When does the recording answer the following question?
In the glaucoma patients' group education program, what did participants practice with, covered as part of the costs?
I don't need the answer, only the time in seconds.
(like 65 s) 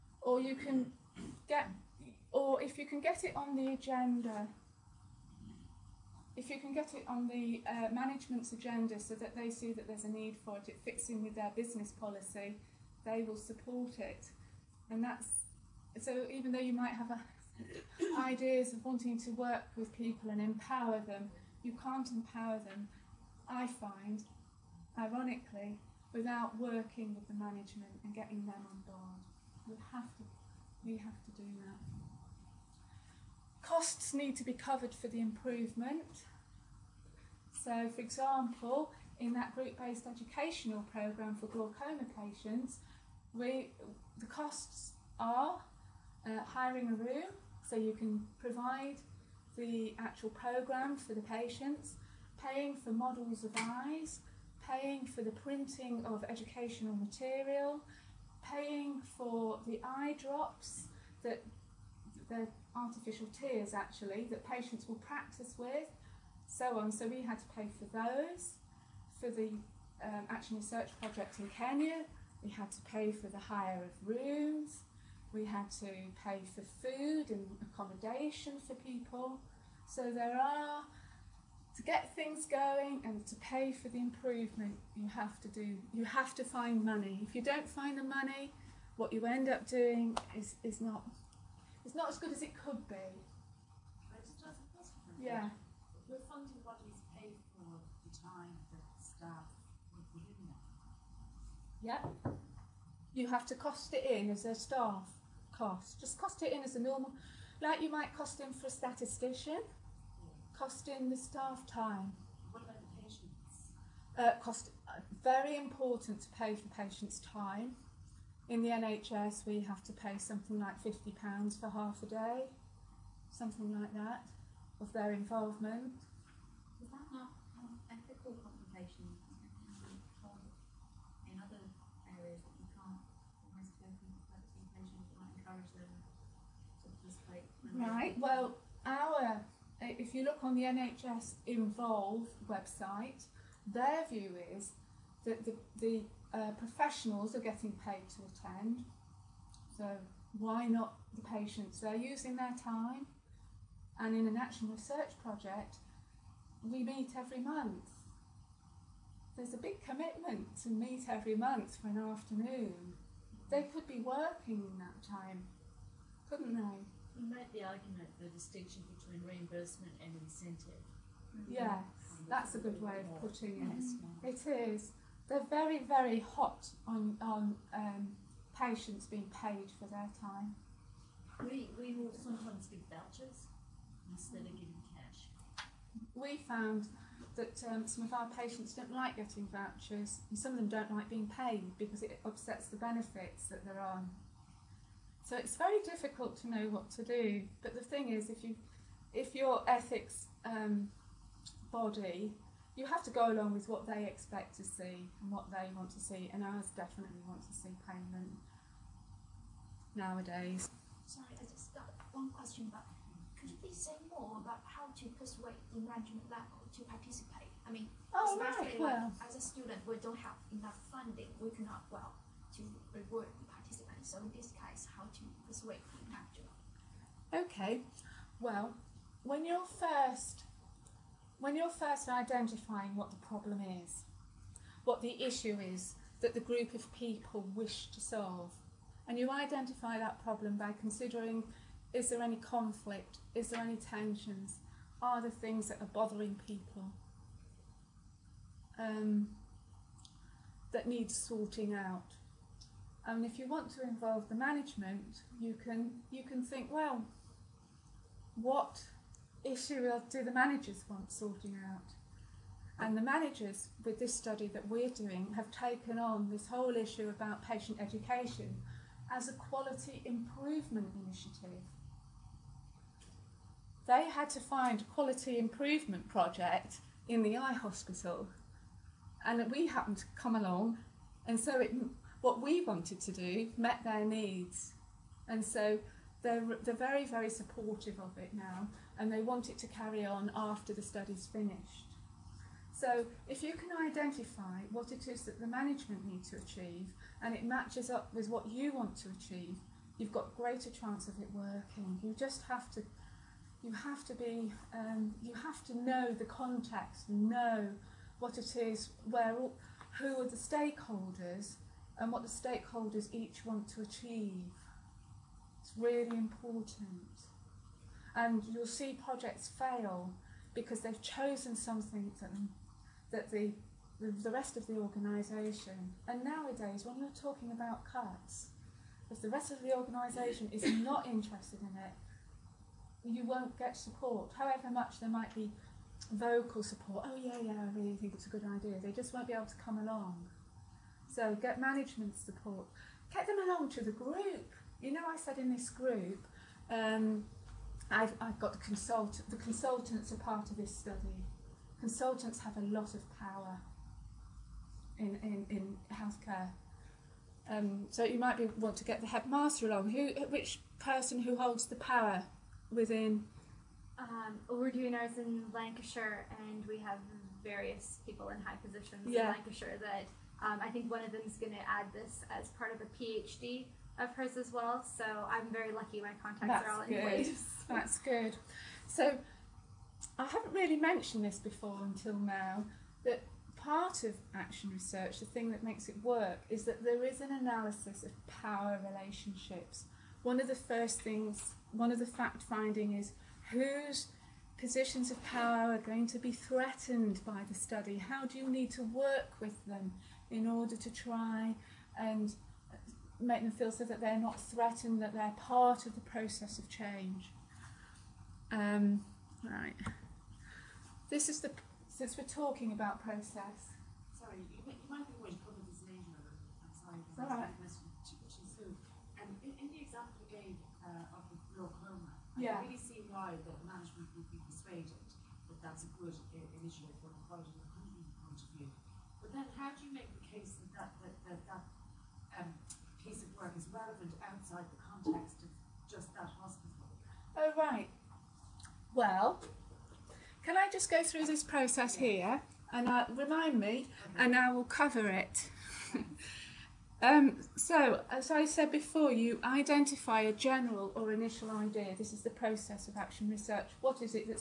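62 s.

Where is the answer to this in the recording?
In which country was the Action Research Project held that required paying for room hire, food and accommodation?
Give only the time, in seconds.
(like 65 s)
71 s.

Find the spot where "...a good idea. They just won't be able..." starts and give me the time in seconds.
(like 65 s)
338 s.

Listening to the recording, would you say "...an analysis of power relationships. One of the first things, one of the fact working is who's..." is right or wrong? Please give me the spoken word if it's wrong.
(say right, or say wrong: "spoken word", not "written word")
wrong: "finding", not "working".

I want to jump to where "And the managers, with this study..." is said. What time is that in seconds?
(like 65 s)
262 s.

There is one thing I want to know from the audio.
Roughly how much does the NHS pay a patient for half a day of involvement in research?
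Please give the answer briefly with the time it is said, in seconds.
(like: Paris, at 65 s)
£50, at 120 s.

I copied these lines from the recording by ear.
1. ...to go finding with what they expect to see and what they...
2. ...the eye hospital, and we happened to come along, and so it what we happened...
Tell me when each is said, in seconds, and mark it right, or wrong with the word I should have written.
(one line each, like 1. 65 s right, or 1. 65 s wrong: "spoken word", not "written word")
1. 203 s wrong: "along", not "finding"
2. 277 s wrong: "wanted", not "happened".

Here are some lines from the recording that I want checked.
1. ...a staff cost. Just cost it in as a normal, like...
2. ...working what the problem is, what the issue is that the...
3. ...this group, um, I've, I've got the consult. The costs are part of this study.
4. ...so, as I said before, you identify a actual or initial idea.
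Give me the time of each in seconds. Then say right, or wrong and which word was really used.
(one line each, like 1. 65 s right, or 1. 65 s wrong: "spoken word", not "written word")
1. 104 s right
2. 232 s wrong: "identifying", not "working"
3. 345 s wrong: "consultants", not "costs"
4. 447 s wrong: "general", not "actual".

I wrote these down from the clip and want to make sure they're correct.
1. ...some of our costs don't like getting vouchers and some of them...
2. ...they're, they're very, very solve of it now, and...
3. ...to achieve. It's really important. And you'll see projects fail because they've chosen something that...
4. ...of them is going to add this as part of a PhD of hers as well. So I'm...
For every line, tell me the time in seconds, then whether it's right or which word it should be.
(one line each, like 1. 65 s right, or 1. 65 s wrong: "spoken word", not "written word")
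1. 187 s wrong: "patients", not "costs"
2. 286 s wrong: "supportive", not "solve"
3. 313 s right
4. 371 s right.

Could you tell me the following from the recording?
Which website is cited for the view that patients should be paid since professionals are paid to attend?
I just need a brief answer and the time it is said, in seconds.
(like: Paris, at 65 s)
NHS Involve, at 140 s.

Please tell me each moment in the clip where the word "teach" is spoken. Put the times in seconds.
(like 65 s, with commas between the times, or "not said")
not said.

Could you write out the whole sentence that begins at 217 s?
I mean, oh, especially right, well.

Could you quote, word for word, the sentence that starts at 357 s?
Um, so you might be, want to get the headmaster along.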